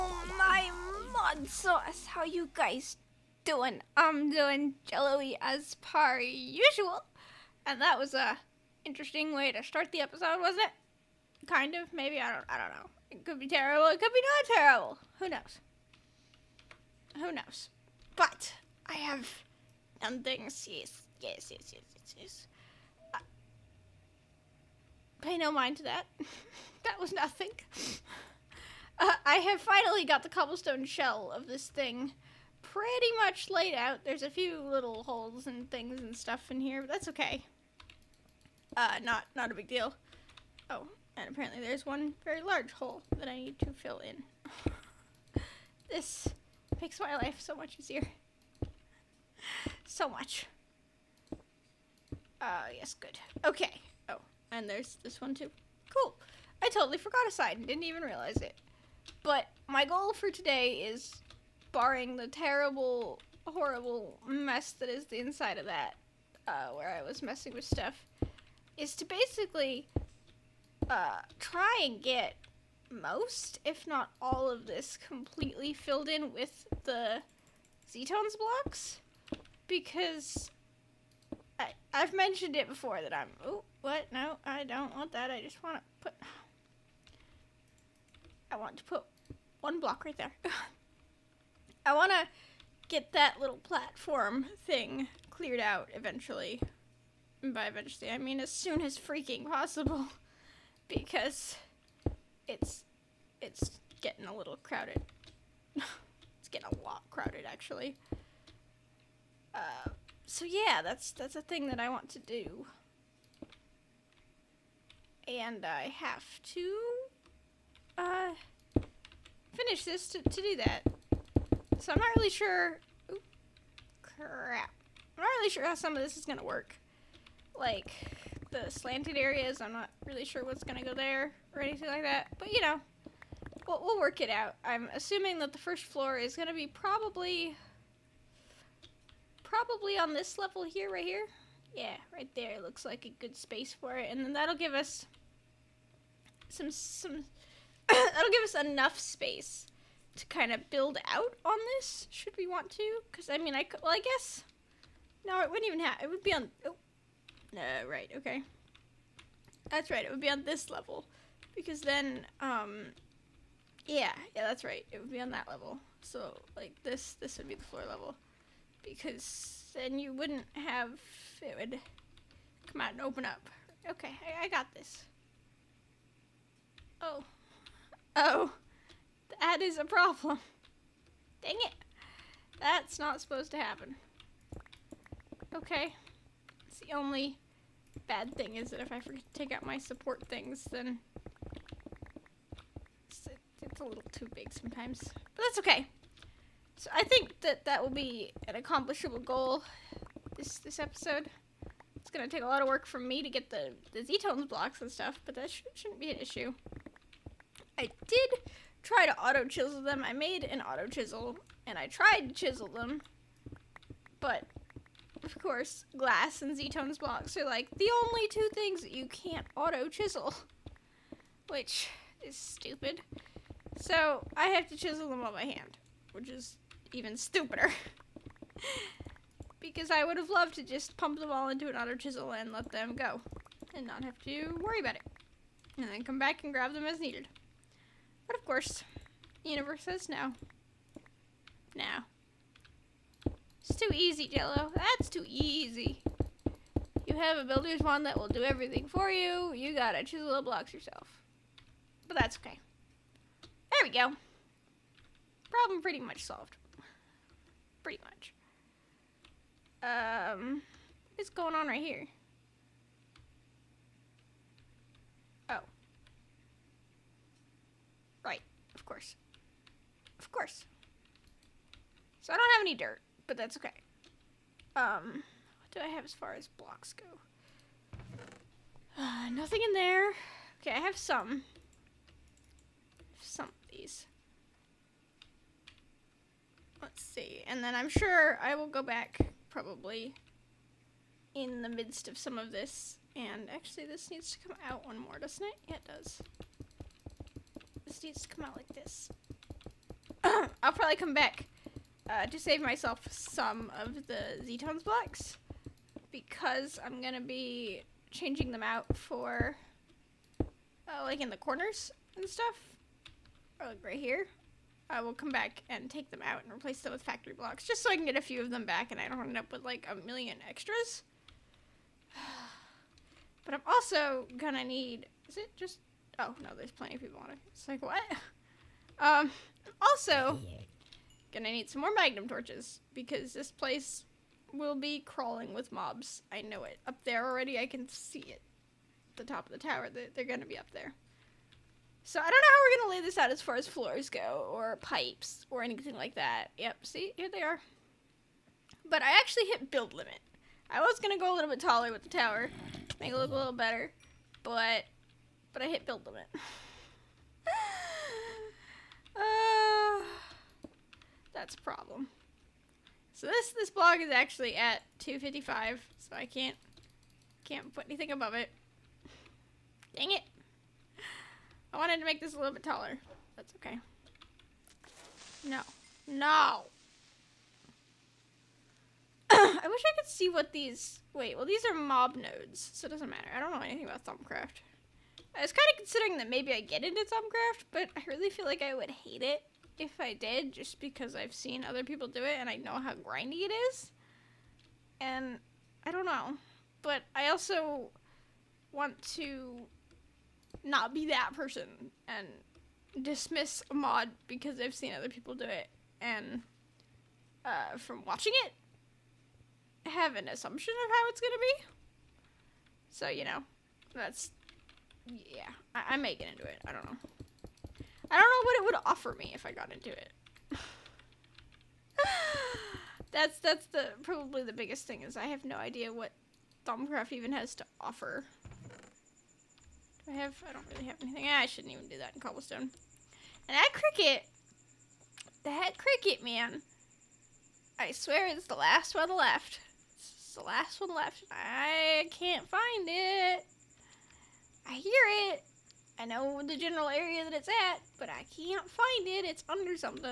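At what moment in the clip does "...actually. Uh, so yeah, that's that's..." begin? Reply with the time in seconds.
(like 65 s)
107 s.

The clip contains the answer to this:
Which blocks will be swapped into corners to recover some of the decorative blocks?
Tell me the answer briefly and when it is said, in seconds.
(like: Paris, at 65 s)
Factory blocks, at 317 s.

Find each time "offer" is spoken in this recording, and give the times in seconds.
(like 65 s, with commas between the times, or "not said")
418 s, 427 s.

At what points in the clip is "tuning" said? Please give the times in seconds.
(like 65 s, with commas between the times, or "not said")
not said.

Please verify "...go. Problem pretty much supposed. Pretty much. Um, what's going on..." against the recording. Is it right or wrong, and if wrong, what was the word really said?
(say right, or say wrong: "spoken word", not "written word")
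wrong: "solved", not "supposed".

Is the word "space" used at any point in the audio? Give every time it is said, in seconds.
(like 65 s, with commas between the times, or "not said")
143 s, 148 s.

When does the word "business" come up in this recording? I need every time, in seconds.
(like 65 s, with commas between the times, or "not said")
not said.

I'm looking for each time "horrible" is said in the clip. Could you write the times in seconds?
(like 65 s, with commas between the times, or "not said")
63 s.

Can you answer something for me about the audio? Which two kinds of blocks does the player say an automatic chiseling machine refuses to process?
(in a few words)
Glass and Z-tones blocks.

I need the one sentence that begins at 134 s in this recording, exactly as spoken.
I'm assuming that the first floor is gonna be probably, probably on this level here, right here.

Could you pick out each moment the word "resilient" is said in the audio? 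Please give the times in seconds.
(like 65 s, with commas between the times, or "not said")
not said.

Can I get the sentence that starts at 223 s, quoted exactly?
So I have to chisel them on my hand, which is even stupider.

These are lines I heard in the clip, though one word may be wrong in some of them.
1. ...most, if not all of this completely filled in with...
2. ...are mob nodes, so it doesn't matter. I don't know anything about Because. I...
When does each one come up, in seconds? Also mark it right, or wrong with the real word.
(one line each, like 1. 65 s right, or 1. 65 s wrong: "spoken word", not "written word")
1. 72 s right
2. 381 s wrong: "Thaumcraft", not "Because".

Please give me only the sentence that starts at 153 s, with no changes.
Because, I mean, I could, well, I guess, no, it wouldn't even have, it would be on, oh, no, uh, right, okay.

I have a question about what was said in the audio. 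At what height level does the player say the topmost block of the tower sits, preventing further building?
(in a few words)
255.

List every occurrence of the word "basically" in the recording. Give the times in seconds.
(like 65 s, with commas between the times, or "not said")
69 s.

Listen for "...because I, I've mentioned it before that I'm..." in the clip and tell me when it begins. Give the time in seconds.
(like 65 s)
79 s.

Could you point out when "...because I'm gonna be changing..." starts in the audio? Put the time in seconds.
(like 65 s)
306 s.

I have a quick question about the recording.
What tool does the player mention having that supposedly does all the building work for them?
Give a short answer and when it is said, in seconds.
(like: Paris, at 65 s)
Builder's wand, at 247 s.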